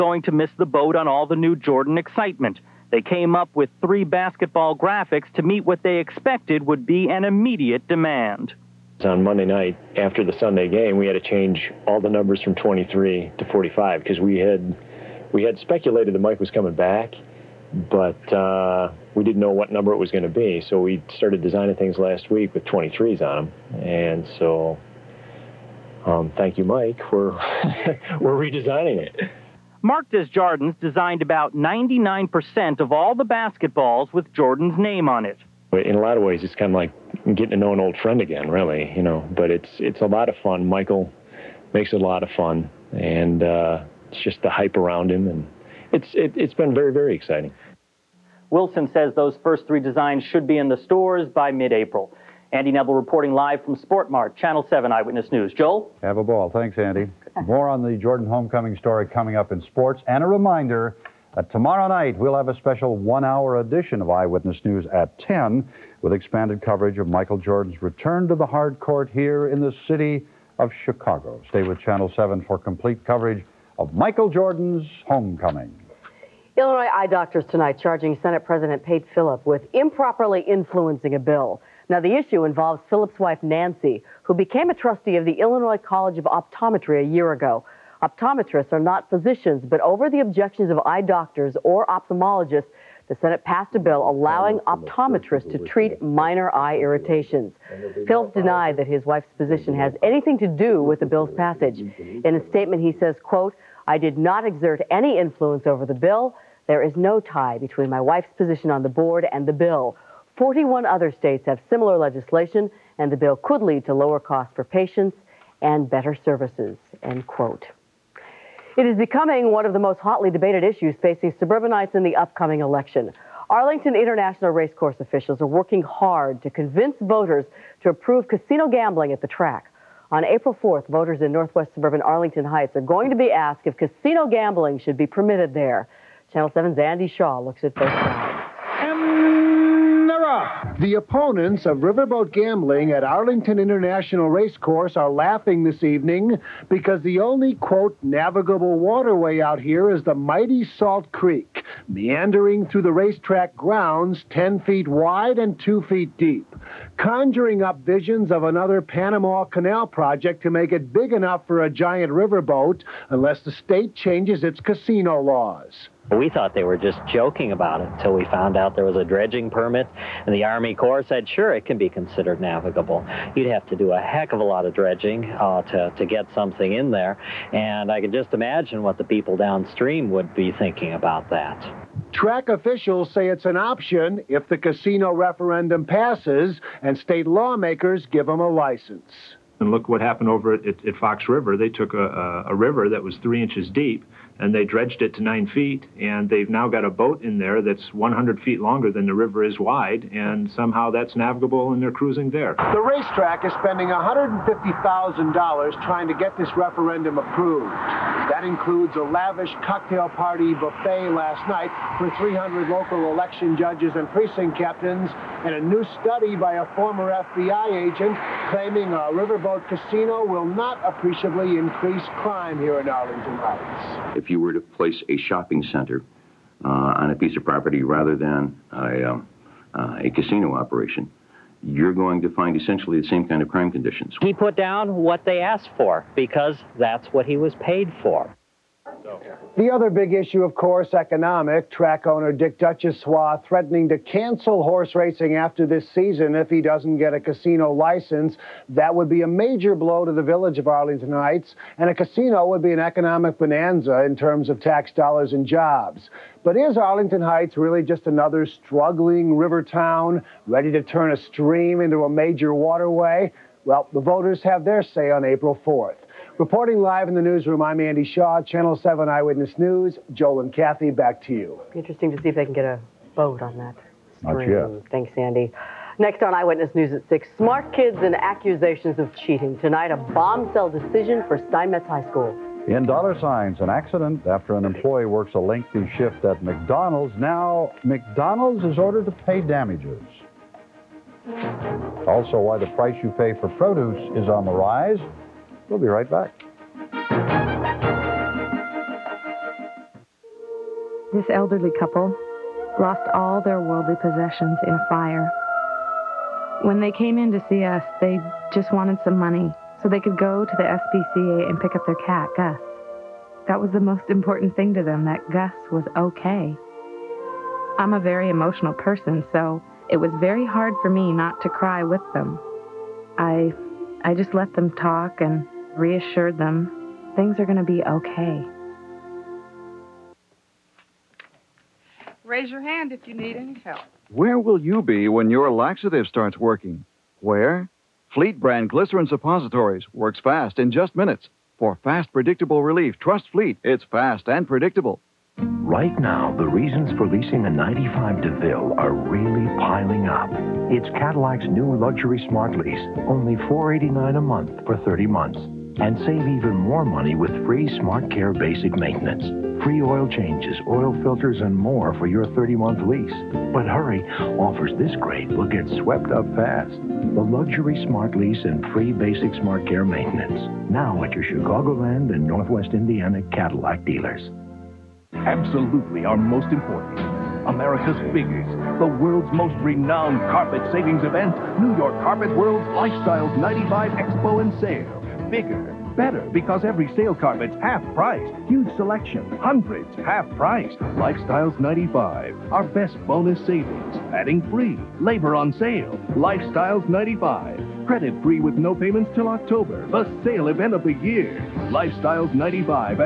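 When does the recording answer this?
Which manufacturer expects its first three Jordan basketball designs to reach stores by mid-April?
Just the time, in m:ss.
0:48.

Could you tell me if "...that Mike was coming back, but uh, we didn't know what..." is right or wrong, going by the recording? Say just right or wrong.
right.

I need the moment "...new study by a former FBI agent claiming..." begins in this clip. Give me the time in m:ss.
3:35.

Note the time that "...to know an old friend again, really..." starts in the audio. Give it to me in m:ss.
0:37.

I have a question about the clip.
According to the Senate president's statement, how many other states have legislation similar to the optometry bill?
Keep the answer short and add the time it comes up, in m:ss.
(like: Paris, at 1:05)
41, at 1:50.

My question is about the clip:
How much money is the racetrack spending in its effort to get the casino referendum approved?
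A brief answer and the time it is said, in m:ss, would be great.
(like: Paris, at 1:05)
$150,000, at 3:23.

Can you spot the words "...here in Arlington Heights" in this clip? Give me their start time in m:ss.
3:42.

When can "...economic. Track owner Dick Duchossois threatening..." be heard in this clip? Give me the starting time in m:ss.
4:00.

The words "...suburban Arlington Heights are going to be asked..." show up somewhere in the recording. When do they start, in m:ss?
2:11.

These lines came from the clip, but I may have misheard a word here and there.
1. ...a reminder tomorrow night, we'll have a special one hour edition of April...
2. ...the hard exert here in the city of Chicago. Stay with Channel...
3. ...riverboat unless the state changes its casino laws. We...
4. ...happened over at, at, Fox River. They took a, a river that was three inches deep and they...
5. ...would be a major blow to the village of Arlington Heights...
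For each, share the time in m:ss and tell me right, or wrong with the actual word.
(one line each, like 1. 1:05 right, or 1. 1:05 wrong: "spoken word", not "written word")
1. 1:00 wrong: "Eyewitness", not "April"
2. 1:08 wrong: "court", not "exert"
3. 2:42 right
4. 3:10 right
5. 4:08 right.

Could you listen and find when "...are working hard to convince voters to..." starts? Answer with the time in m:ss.
2:05.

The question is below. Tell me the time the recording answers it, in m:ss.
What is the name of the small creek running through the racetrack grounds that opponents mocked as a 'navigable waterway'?
2:30.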